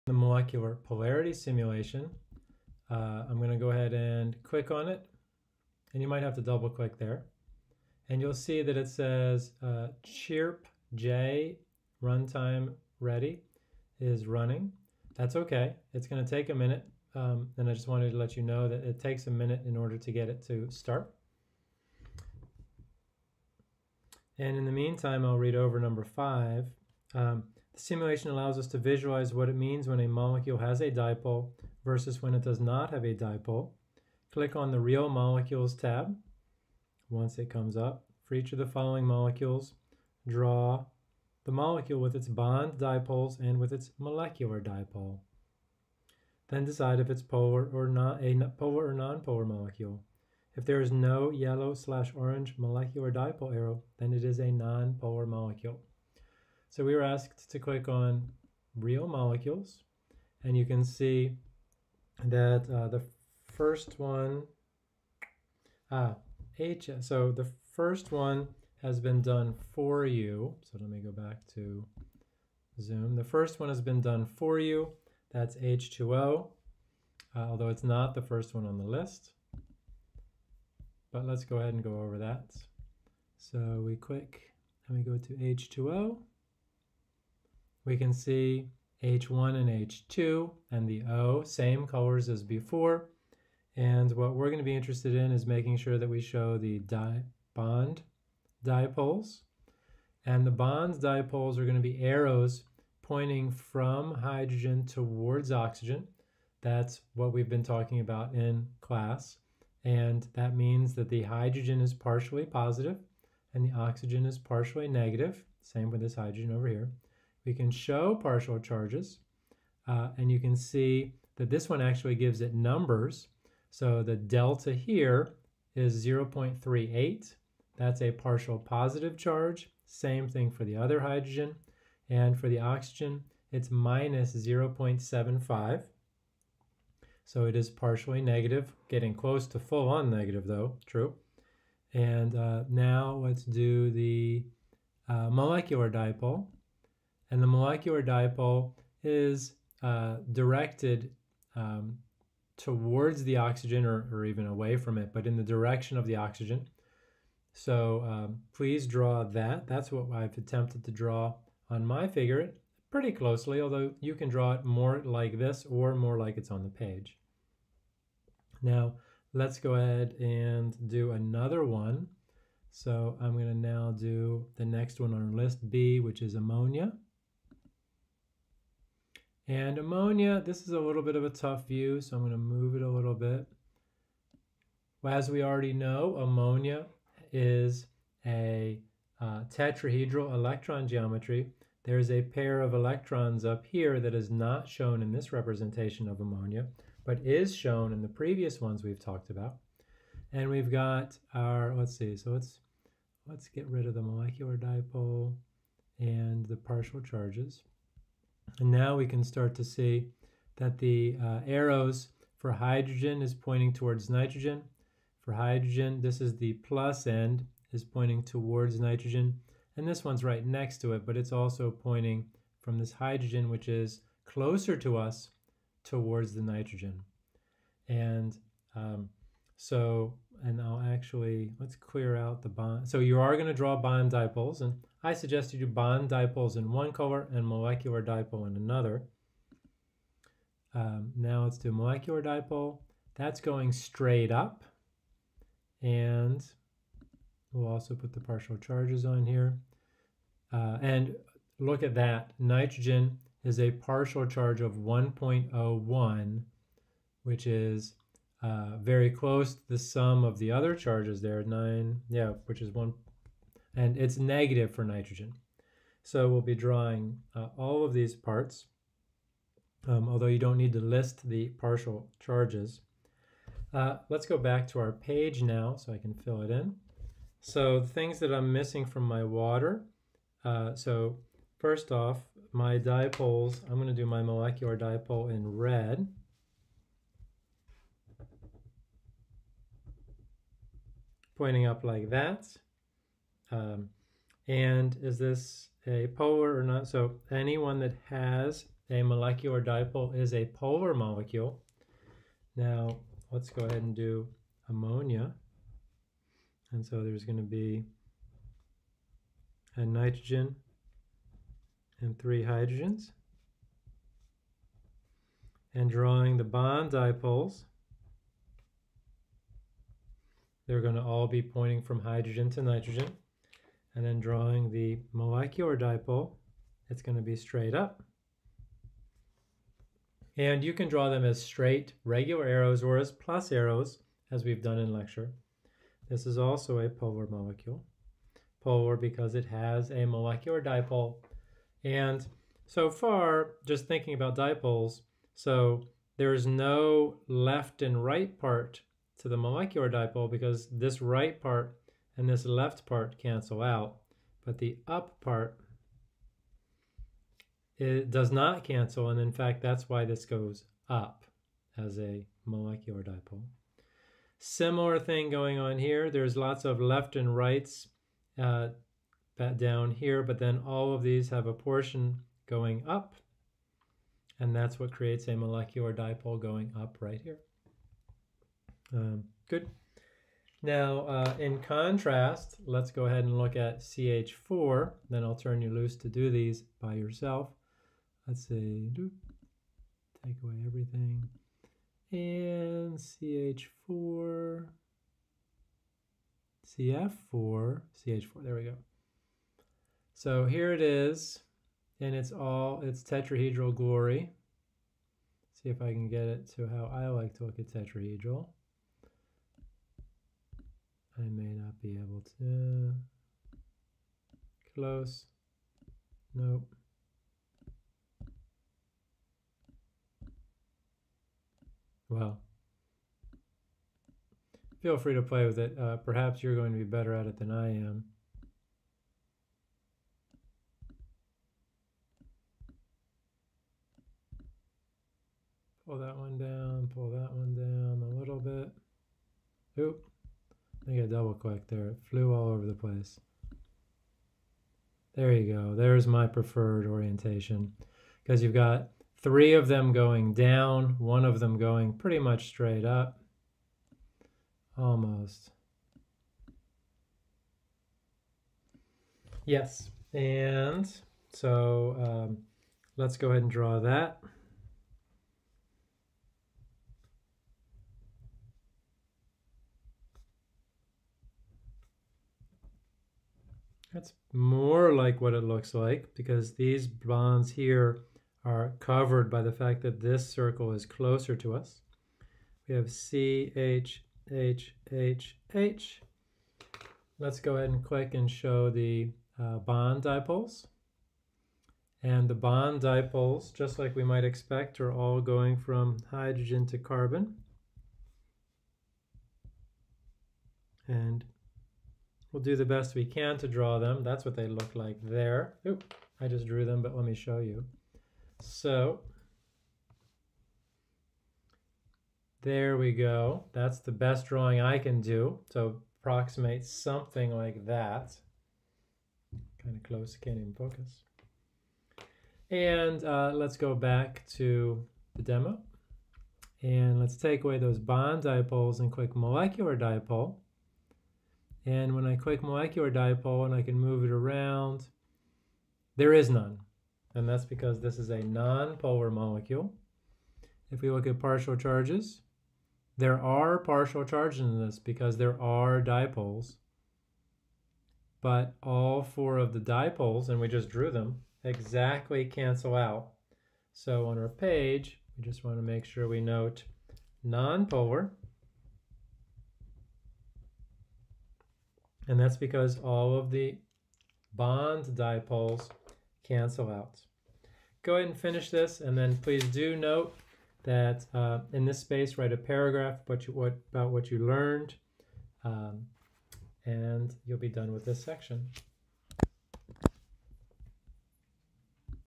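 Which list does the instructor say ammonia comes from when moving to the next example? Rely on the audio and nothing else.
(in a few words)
list B.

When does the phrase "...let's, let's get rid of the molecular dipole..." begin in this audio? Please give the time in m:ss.
3:22.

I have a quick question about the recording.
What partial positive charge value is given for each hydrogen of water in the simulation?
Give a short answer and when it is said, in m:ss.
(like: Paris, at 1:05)
0.38, at 2:06.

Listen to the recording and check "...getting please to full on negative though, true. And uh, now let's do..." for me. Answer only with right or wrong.
wrong.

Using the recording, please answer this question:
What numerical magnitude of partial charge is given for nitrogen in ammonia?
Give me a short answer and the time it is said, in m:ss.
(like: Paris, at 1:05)
1.01, at 4:14.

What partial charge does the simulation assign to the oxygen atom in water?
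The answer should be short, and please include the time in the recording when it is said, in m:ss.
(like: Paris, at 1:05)
-0.75, at 2:13.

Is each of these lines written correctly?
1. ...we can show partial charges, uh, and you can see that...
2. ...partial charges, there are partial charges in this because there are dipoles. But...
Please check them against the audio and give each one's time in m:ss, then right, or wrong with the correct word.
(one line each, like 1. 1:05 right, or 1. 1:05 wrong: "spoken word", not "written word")
1. 1:57 right
2. 9:01 right.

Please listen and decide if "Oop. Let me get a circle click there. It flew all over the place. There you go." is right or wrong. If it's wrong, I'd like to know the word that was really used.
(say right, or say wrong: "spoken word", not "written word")
wrong: "double", not "circle".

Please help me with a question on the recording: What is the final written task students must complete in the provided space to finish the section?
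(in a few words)
a paragraph.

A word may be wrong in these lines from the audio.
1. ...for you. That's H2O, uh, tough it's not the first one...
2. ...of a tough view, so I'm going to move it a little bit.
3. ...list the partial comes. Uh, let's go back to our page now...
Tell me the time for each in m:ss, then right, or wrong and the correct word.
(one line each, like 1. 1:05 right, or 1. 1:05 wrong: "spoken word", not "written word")
1. 1:14 wrong: "although", not "tough"
2. 3:01 right
3. 4:30 wrong: "charges", not "comes".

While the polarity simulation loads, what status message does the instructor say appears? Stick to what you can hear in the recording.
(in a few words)
chirp J runtime ready.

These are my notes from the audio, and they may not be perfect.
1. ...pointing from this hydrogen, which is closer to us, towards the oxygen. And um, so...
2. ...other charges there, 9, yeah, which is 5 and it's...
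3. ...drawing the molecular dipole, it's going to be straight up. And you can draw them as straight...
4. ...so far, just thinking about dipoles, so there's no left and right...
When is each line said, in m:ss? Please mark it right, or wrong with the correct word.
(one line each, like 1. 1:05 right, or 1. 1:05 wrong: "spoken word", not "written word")
1. 3:41 wrong: "nitrogen", not "oxygen"
2. 4:20 wrong: "1", not "5"
3. 5:24 right
4. 5:42 right.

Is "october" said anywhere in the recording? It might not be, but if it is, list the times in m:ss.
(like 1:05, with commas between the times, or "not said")
not said.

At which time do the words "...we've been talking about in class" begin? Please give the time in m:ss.
1:47.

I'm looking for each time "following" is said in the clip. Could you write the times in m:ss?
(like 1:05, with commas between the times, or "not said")
0:38.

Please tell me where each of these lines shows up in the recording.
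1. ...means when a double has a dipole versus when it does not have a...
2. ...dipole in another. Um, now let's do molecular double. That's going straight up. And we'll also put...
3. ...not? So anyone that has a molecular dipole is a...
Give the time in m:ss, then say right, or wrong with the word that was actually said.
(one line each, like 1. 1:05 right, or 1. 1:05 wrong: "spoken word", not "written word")
1. 0:29 wrong: "molecule", not "double"
2. 3:58 wrong: "dipole", not "double"
3. 4:56 right.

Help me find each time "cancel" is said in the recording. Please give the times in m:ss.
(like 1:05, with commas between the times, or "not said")
5:53, 5:58, 9:12, 9:26.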